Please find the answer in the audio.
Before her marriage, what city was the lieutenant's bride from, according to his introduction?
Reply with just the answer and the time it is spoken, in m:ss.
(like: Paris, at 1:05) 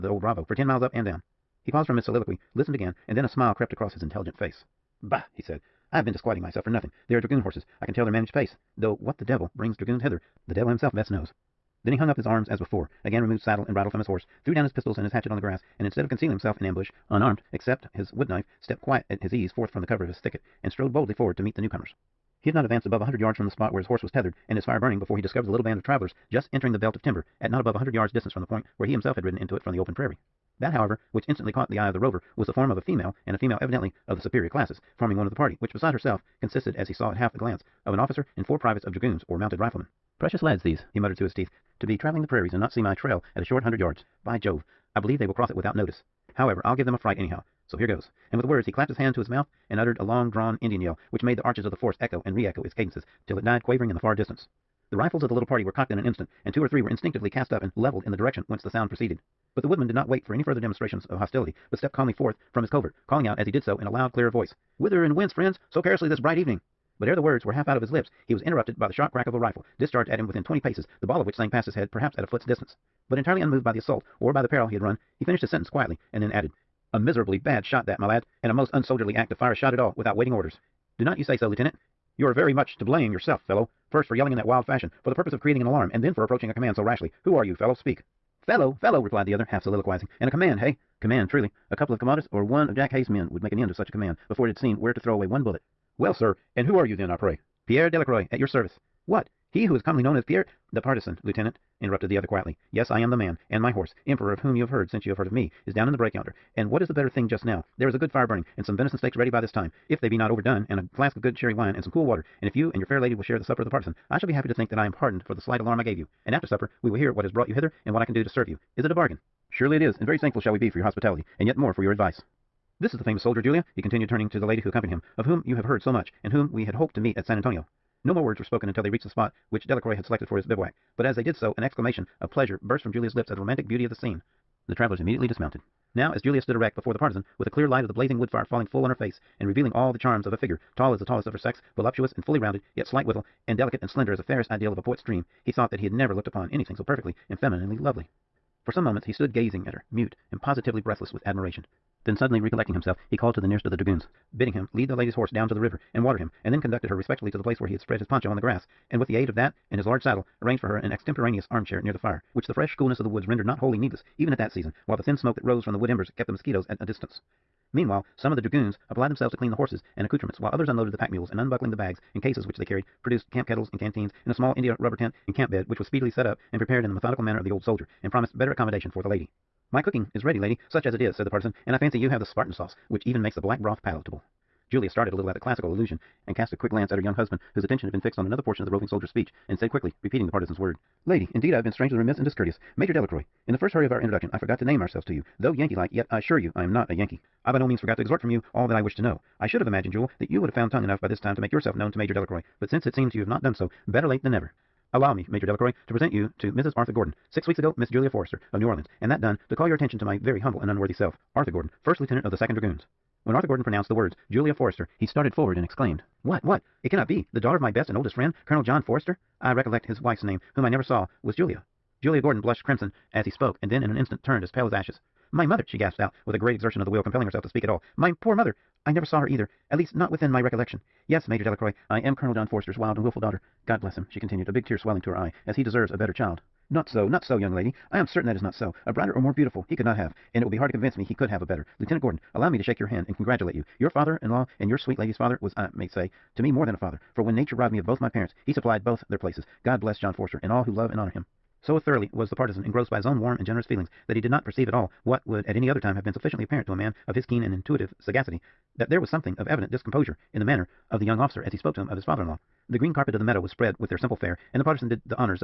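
New Orleans, at 3:28.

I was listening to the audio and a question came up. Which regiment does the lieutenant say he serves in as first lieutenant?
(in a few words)
Second dragoons.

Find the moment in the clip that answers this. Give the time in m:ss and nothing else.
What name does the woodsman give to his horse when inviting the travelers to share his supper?
1:44.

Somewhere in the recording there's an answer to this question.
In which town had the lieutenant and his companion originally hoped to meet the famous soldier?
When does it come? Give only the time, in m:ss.
2:07.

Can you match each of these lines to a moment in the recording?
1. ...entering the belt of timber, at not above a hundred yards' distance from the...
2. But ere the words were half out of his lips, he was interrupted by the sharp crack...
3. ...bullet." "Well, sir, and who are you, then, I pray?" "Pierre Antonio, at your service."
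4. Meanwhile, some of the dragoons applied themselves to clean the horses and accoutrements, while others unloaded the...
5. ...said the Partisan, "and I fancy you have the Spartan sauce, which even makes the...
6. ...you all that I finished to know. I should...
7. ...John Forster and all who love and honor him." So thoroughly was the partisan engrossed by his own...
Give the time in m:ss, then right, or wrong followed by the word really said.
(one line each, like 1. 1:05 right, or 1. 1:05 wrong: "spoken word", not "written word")
1. 0:26 right
2. 1:07 right
3. 1:35 wrong: "Delacroix", not "Antonio"
4. 2:47 right
5. 3:01 right
6. 3:18 wrong: "wished", not "finished"
7. 4:09 right.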